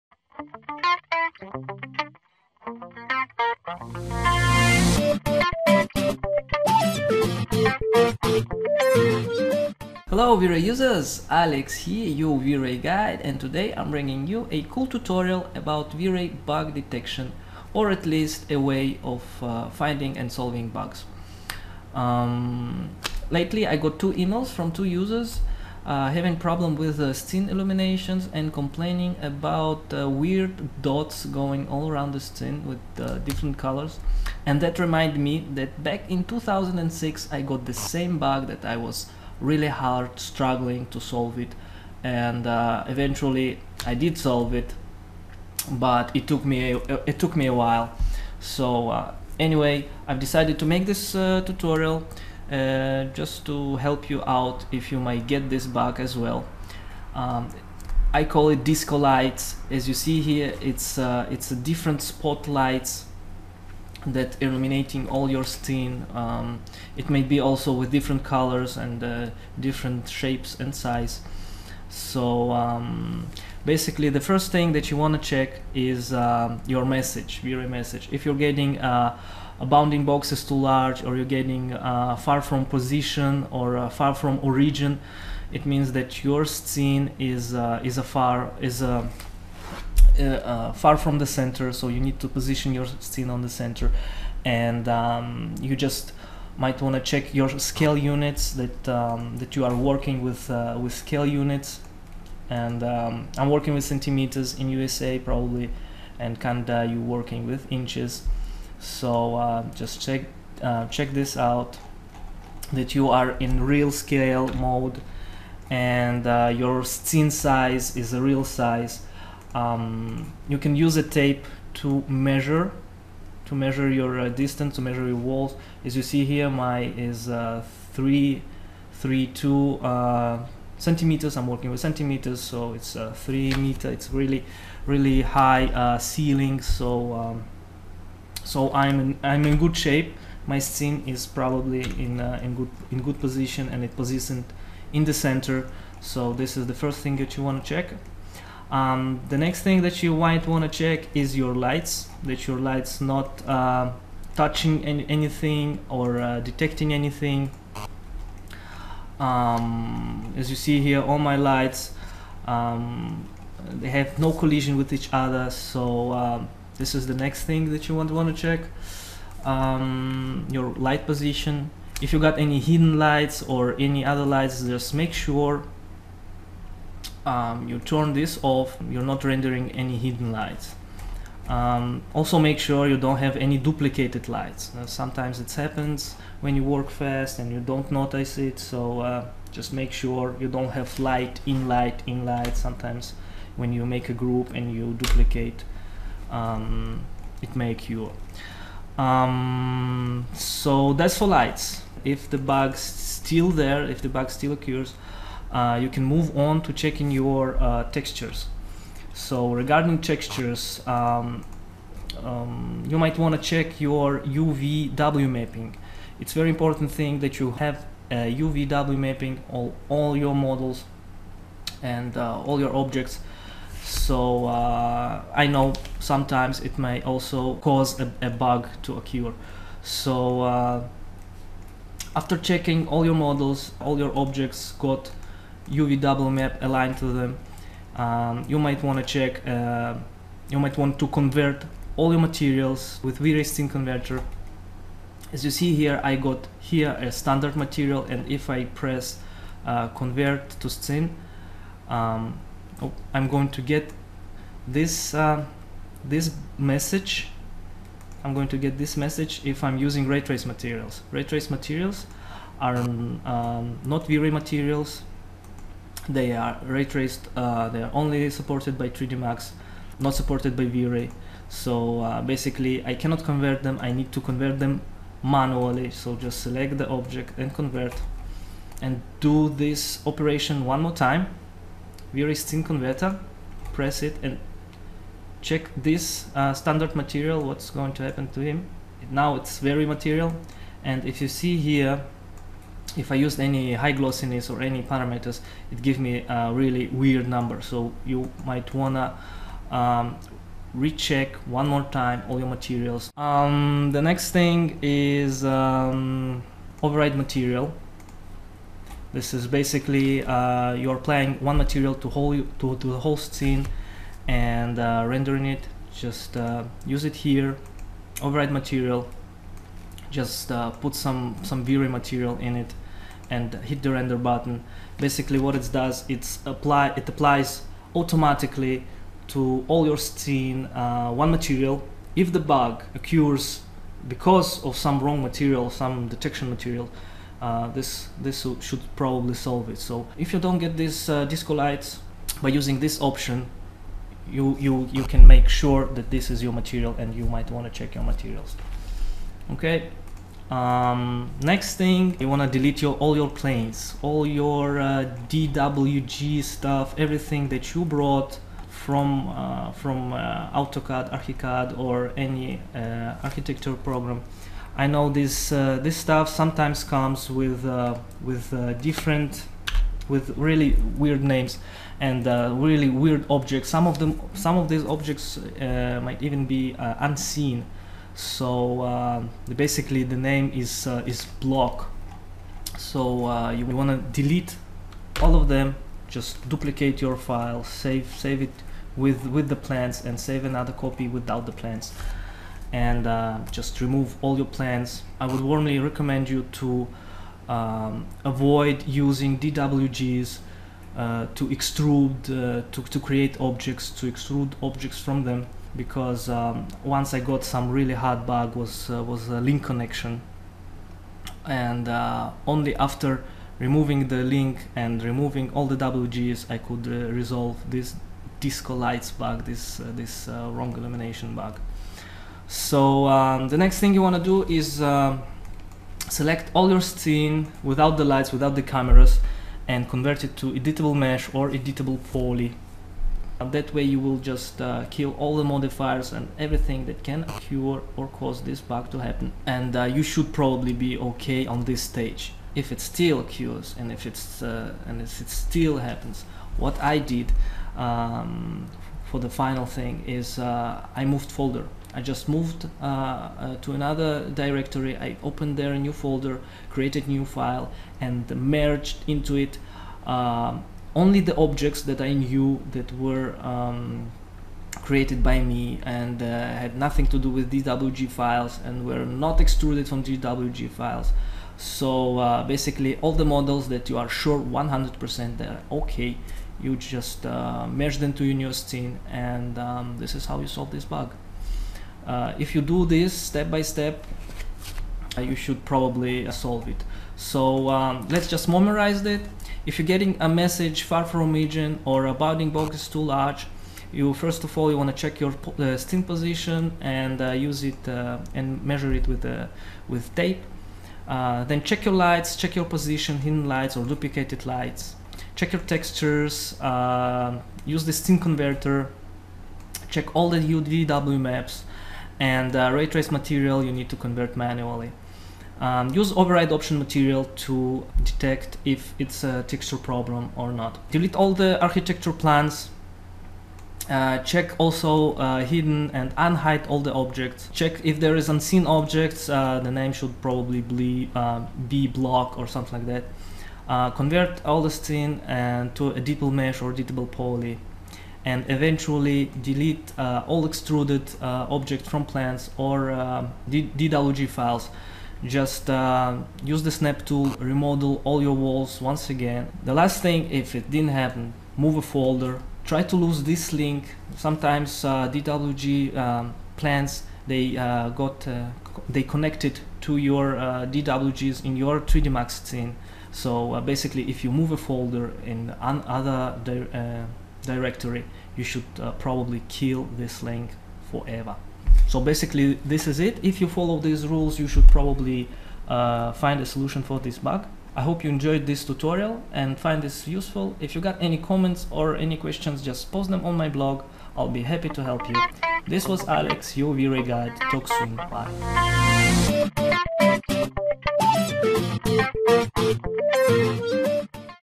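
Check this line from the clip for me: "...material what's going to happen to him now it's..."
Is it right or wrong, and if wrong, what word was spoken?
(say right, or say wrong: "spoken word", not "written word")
right.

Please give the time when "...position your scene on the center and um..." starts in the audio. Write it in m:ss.
1:32.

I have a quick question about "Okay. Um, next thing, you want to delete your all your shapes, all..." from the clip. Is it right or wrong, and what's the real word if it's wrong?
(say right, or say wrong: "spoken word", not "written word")
wrong: "planes", not "shapes".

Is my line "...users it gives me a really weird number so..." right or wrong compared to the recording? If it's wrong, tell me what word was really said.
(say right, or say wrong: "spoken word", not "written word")
wrong: "parameters", not "users".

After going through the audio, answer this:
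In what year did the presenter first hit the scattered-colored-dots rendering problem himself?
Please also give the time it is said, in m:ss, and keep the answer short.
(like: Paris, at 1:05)
2006, at 0:36.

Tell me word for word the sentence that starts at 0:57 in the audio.
Um, I call it disco lights.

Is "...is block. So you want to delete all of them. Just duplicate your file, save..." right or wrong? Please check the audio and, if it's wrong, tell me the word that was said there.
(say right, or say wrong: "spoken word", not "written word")
right.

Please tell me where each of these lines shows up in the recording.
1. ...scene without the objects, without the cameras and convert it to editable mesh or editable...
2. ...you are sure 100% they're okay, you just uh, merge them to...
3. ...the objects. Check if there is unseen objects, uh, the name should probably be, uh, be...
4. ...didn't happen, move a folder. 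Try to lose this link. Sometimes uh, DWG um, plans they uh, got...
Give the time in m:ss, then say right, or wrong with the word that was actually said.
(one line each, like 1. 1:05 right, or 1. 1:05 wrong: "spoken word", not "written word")
1. 7:06 wrong: "lights", not "objects"
2. 7:53 right
3. 8:46 right
4. 9:10 right.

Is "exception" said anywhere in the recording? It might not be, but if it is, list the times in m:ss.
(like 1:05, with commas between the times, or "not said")
not said.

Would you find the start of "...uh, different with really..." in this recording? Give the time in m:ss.
6:08.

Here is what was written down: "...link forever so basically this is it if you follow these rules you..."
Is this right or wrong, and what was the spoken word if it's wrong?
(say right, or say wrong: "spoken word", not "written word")
right.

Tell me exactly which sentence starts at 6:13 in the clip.
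Some of them some of these objects uh, might even be uh, unseen.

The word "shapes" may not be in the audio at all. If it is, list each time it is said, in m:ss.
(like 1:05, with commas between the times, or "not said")
1:10, 2:19.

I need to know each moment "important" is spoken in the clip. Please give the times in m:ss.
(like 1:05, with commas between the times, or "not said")
3:36.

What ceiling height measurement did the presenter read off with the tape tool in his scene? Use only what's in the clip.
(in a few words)
332 centimeters.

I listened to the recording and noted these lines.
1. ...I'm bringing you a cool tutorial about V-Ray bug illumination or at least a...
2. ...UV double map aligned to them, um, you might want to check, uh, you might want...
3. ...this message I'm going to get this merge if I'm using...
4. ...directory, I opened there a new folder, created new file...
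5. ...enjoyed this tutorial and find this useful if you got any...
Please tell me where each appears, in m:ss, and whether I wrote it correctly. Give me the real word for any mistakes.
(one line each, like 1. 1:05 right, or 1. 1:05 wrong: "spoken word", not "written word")
1. 0:13 wrong: "detection", not "illumination"
2. 3:55 right
3. 4:16 wrong: "message", not "merge"
4. 7:34 right
5. 9:38 right.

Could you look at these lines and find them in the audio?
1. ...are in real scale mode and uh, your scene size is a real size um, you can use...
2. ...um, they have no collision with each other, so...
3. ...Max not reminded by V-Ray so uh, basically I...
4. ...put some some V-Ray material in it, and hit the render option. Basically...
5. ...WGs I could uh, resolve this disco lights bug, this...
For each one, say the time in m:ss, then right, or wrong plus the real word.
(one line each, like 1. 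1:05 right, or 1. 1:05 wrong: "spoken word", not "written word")
1. 1:53 right
2. 2:42 right
3. 4:29 wrong: "supported", not "reminded"
4. 5:20 wrong: "button", not "option"
5. 6:55 right.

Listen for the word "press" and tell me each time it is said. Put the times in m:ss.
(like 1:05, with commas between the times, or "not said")
4:08, 4:43.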